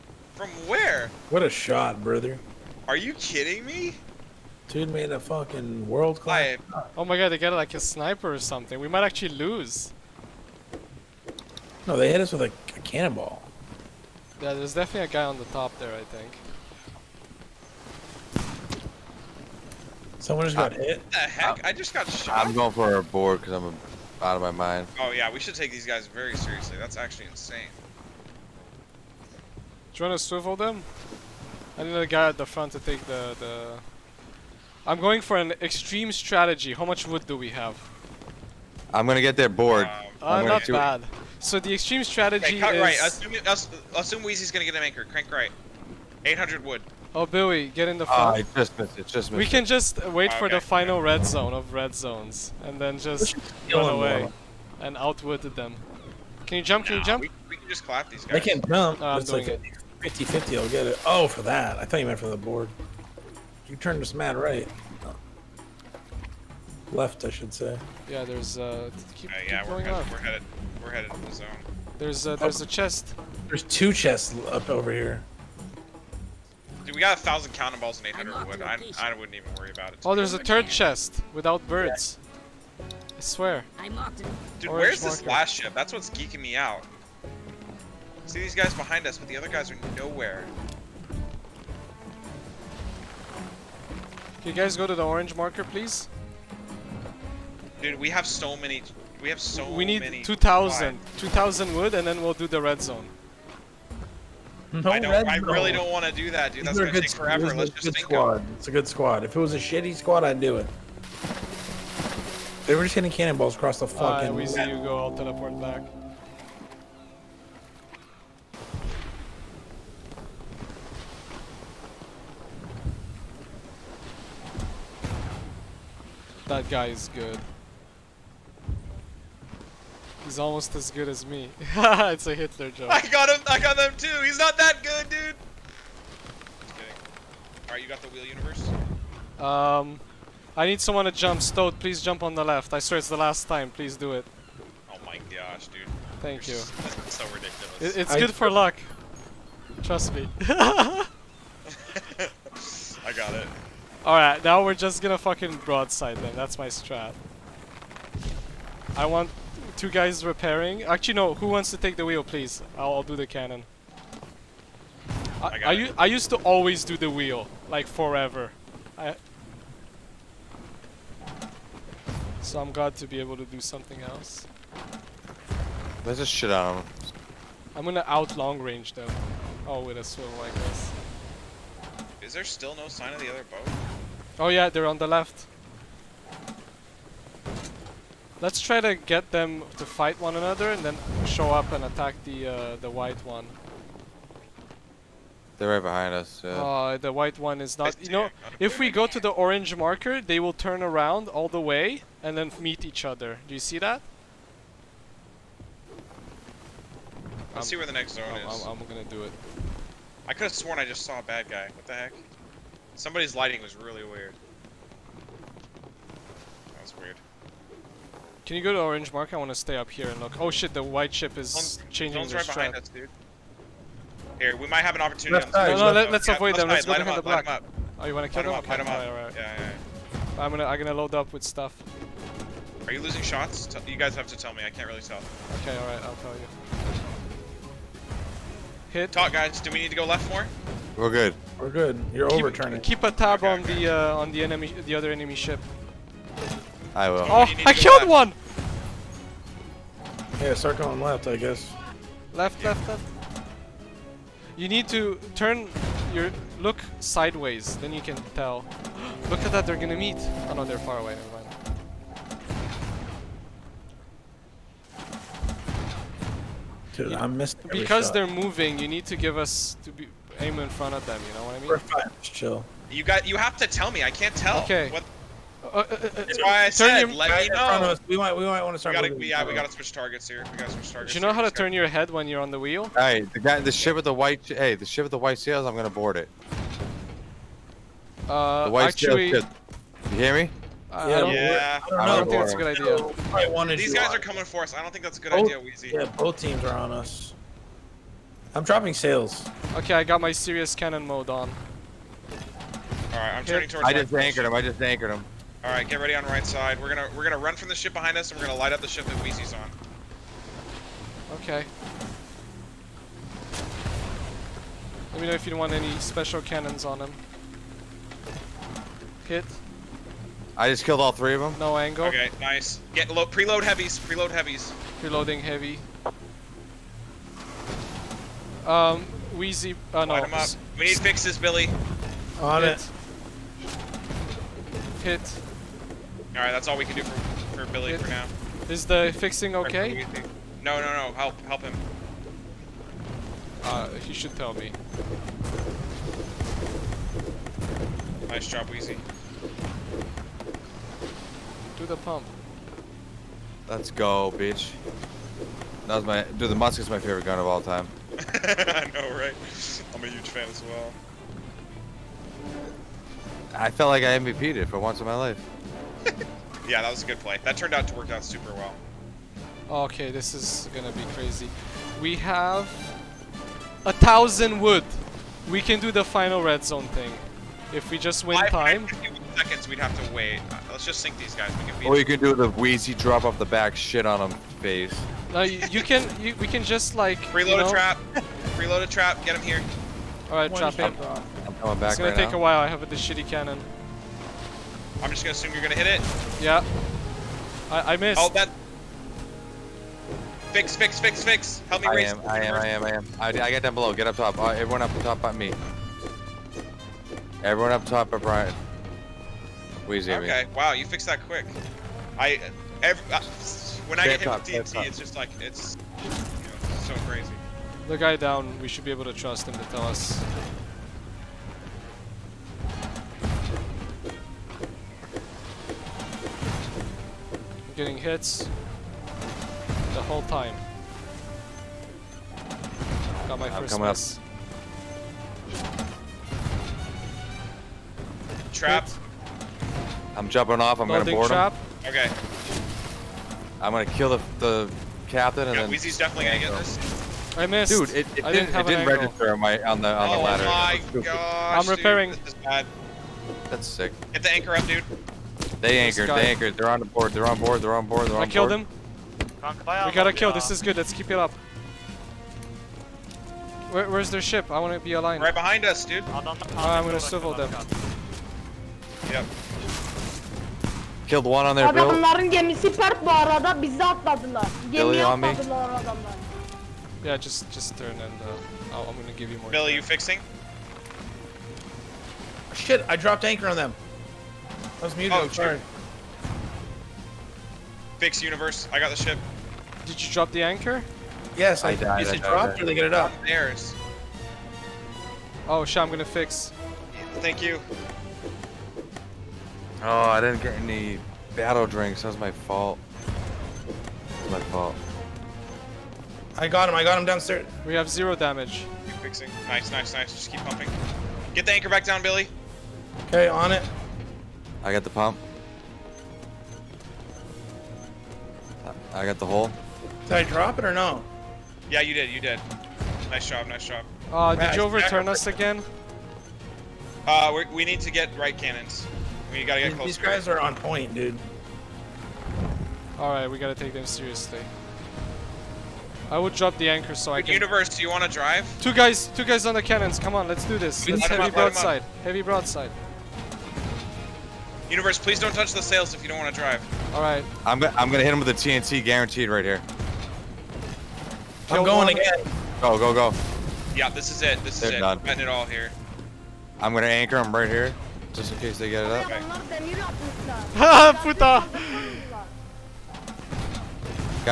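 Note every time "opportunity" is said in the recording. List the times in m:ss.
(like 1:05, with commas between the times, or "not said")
3:45.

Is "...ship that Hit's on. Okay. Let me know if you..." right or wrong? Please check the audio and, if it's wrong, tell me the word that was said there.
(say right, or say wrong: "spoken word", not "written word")
wrong: "Weezy", not "Hit".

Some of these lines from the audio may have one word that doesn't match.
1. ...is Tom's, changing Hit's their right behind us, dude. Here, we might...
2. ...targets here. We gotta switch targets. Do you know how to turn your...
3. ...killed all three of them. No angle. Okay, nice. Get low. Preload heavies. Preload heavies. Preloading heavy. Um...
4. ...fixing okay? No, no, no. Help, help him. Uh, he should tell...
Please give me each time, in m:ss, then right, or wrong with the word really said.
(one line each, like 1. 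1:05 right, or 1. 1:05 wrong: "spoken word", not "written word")
1. 3:41 wrong: "Tom", not "Hit"
2. 4:39 right
3. 5:20 right
4. 5:39 right.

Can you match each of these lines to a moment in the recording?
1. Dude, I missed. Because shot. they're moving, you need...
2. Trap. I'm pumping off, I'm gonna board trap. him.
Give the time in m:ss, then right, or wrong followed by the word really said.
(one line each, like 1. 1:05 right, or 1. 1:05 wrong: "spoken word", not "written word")
1. 4:26 right
2. 7:18 wrong: "jumping", not "pumping".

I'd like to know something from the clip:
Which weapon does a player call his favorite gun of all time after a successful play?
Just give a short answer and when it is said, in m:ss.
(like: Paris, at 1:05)
musket, at 5:56.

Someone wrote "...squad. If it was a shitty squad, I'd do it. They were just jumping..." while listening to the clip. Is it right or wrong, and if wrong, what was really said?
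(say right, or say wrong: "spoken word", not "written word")
wrong: "hitting", not "jumping".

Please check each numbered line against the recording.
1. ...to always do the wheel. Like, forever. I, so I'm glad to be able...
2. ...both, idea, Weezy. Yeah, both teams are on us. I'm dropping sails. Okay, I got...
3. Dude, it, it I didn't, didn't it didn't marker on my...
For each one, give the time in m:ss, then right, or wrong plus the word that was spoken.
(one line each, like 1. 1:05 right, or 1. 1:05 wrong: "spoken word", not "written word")
1. 2:46 right
2. 4:55 right
3. 7:27 wrong: "register", not "marker".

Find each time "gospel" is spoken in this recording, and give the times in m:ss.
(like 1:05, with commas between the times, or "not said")
not said.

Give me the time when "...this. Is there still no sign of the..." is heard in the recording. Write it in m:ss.
3:00.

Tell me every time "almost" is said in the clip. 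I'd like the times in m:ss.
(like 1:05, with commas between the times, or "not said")
2:10.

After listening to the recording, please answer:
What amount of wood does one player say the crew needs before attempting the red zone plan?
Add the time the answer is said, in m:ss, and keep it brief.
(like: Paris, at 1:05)
2,000, at 1:41.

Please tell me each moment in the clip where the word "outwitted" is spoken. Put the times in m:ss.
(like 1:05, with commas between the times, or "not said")
0:54.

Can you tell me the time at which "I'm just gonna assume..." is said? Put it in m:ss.
6:35.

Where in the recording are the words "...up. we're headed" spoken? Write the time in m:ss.
1:09.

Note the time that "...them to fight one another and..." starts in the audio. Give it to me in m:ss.
3:09.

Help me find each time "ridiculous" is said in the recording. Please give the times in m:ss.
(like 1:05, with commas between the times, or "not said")
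2:27.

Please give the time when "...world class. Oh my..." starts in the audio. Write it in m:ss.
0:05.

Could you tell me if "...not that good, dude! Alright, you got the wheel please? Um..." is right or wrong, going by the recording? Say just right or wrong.
wrong.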